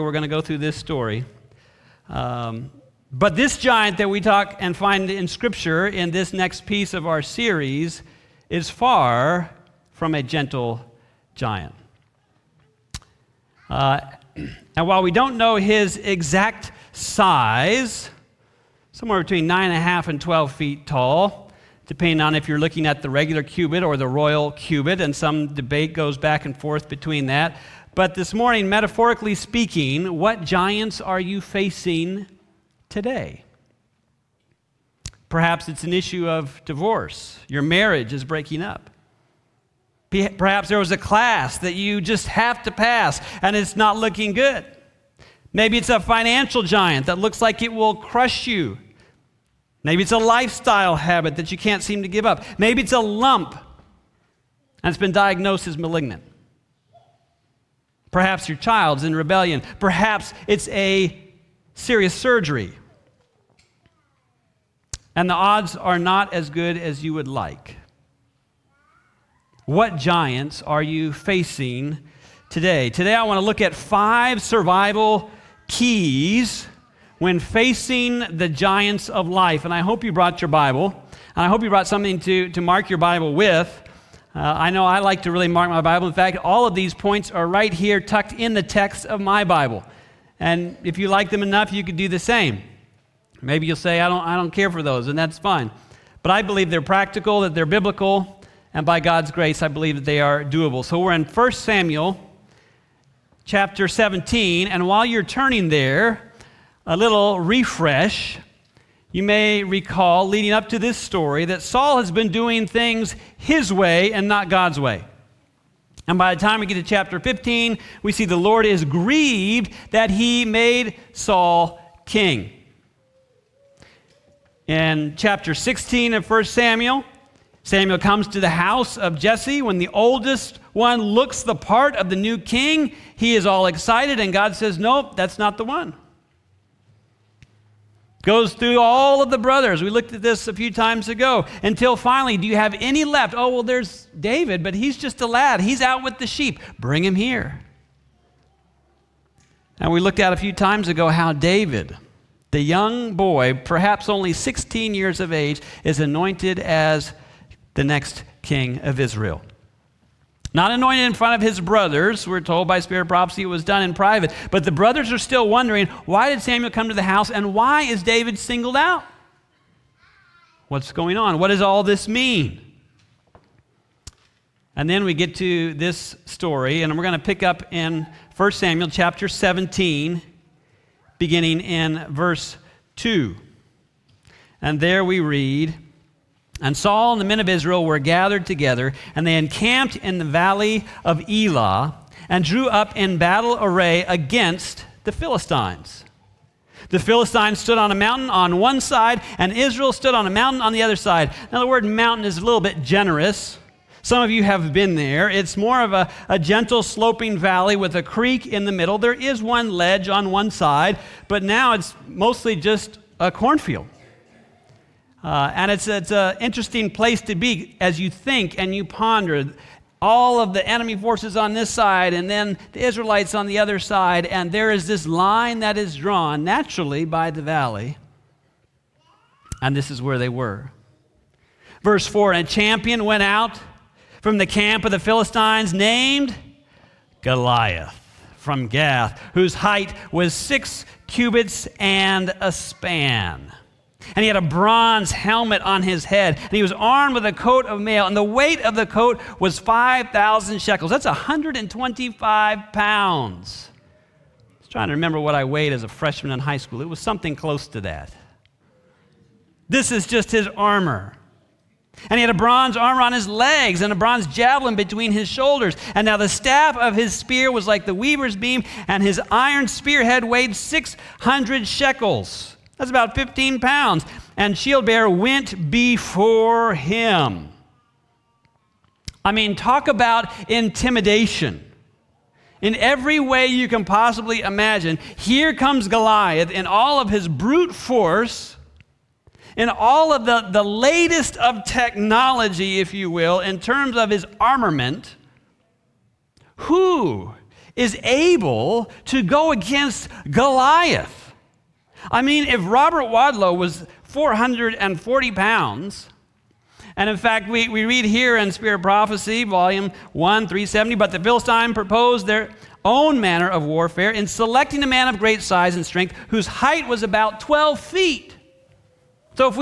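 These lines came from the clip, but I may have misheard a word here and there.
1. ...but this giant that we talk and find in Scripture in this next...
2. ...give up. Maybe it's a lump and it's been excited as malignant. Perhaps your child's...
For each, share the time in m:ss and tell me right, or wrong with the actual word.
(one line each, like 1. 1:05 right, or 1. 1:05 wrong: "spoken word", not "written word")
1. 0:03 right
2. 0:52 wrong: "diagnosed", not "excited".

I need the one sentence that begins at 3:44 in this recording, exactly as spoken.
And there is this line that is drawn naturally by the valley.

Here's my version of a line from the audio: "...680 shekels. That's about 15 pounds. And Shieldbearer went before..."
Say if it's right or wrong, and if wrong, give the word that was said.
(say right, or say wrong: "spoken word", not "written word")
wrong: "600", not "680".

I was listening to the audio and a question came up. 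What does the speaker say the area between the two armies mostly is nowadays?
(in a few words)
A cornfield.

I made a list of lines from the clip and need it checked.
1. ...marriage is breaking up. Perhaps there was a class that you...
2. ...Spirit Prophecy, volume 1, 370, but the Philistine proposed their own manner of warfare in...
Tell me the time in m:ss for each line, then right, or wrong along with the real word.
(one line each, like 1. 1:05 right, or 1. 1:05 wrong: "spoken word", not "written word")
1. 0:37 right
2. 5:08 right.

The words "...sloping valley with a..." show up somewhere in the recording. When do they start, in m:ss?
3:26.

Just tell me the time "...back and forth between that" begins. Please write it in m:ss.
0:26.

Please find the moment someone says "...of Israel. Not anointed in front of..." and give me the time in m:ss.
2:38.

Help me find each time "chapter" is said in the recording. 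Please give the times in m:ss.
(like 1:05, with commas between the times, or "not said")
1:43, 1:56, 2:05, 2:58.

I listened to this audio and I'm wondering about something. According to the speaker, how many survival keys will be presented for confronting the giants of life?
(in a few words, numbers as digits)
5.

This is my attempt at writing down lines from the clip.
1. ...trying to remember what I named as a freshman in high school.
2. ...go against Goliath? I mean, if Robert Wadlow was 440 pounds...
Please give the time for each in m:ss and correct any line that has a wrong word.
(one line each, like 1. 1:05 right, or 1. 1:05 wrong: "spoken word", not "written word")
1. 4:14 wrong: "weighed", not "named"
2. 4:59 right.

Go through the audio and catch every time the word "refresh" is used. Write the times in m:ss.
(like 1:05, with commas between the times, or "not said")
1:47.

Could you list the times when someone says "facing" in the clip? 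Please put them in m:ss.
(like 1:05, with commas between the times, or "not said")
0:31, 1:11, 1:17.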